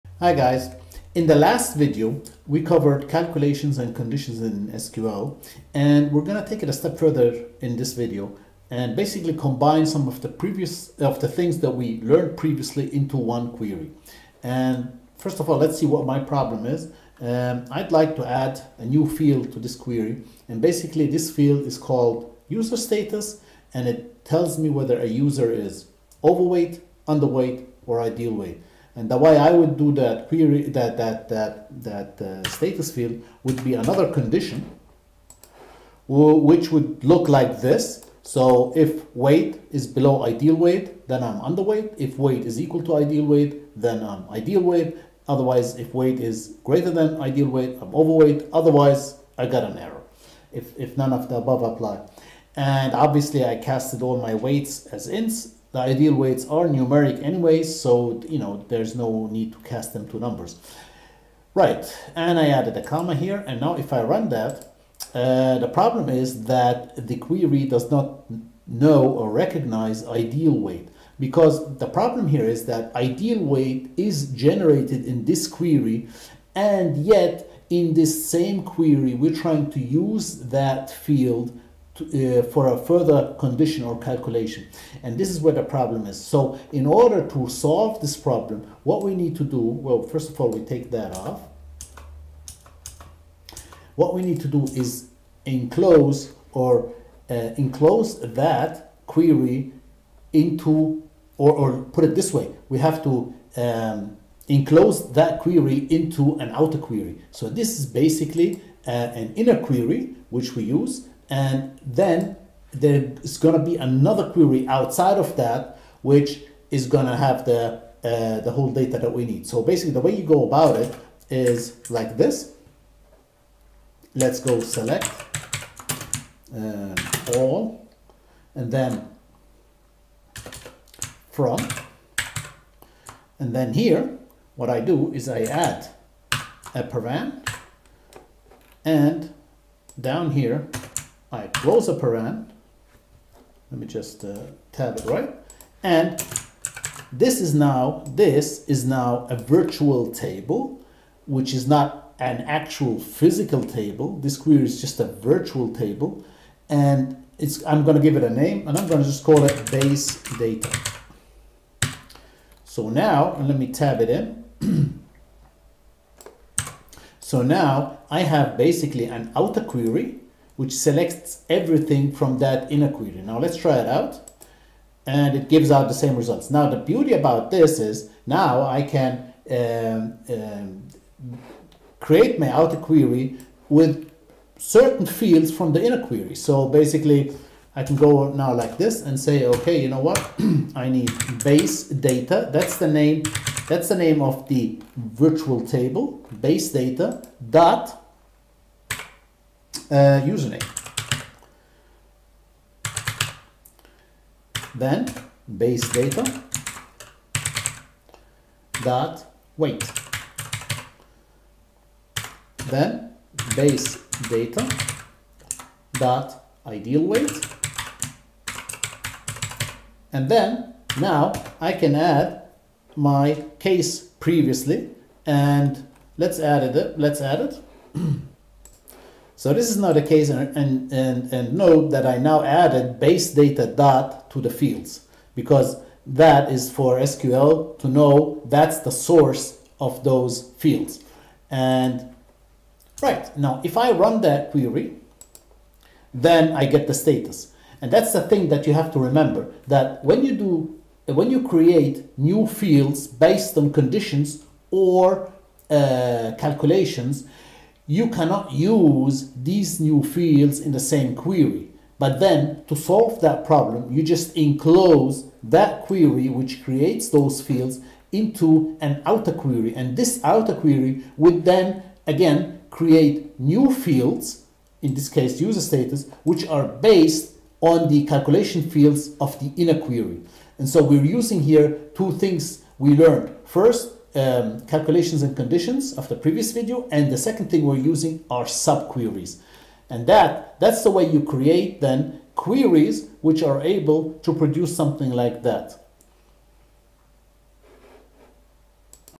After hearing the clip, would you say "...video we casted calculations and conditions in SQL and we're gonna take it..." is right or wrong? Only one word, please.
wrong.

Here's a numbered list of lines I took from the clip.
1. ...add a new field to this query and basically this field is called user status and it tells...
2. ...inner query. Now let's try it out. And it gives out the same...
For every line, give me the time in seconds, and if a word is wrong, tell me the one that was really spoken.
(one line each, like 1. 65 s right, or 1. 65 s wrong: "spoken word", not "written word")
1. 18 s right
2. 172 s right.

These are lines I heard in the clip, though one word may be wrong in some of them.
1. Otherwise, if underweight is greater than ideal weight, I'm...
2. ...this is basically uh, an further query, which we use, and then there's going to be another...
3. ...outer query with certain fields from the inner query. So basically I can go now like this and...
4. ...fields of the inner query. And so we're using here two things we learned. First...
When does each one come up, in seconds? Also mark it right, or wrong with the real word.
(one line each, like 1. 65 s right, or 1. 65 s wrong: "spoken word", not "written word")
1. 45 s wrong: "weight", not "underweight"
2. 107 s wrong: "inner", not "further"
3. 182 s right
4. 278 s right.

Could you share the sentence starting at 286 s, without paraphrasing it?
And the second thing we're using are subqueries.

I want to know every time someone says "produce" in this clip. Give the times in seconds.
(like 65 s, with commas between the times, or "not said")
294 s.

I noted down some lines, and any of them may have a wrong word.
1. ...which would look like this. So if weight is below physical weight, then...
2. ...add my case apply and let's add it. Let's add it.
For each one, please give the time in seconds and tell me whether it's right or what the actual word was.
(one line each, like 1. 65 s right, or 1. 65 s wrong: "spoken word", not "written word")
1. 36 s wrong: "ideal", not "physical"
2. 221 s wrong: "previously", not "apply".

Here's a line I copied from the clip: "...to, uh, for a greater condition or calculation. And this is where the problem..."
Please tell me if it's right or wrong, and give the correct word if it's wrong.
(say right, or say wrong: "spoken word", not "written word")
wrong: "further", not "greater".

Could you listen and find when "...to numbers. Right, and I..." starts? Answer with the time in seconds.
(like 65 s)
60 s.